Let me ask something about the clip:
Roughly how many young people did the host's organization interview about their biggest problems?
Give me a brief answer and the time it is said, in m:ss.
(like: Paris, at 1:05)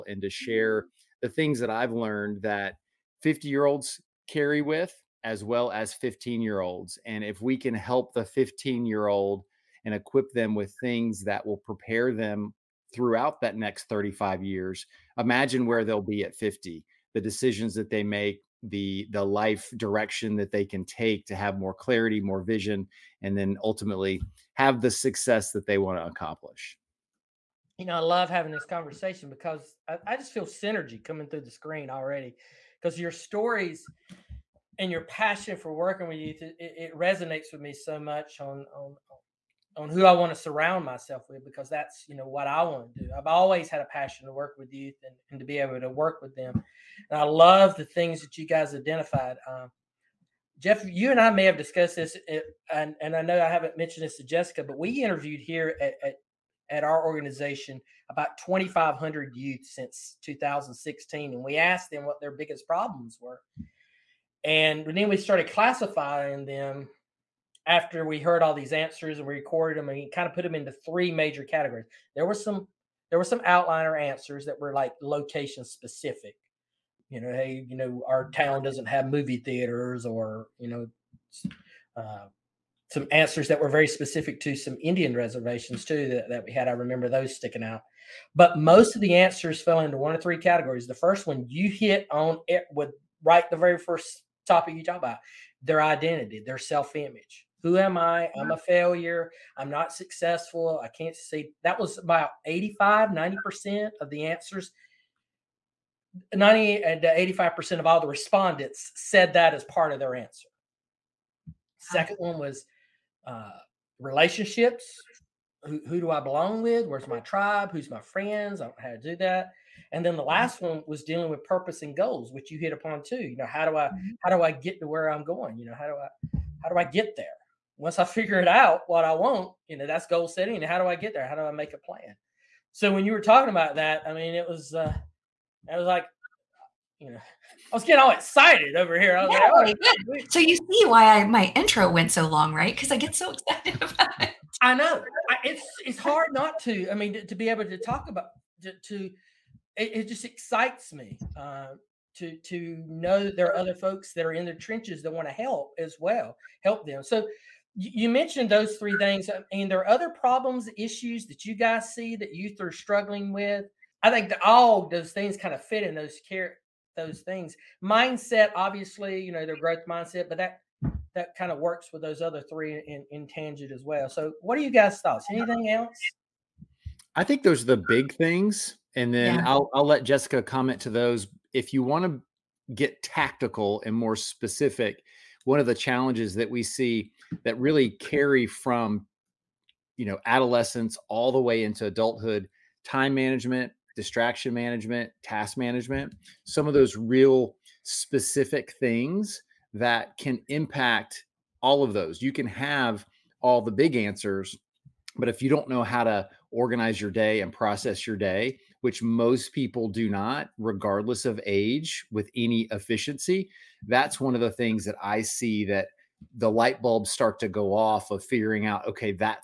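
2,500, at 0:58.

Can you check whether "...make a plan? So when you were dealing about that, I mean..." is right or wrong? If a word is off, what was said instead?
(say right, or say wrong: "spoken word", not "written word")
wrong: "talking", not "dealing".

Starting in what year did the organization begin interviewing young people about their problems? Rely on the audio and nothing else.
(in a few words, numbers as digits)
2016.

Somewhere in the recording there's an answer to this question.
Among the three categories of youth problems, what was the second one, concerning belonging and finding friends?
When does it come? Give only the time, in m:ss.
1:53.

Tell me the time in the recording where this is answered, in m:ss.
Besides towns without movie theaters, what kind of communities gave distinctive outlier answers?
1:24.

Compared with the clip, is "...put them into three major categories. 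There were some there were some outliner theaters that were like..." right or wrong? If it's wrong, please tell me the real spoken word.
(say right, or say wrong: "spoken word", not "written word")
wrong: "answers", not "theaters".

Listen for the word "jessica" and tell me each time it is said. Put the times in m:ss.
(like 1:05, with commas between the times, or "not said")
0:54, 3:00.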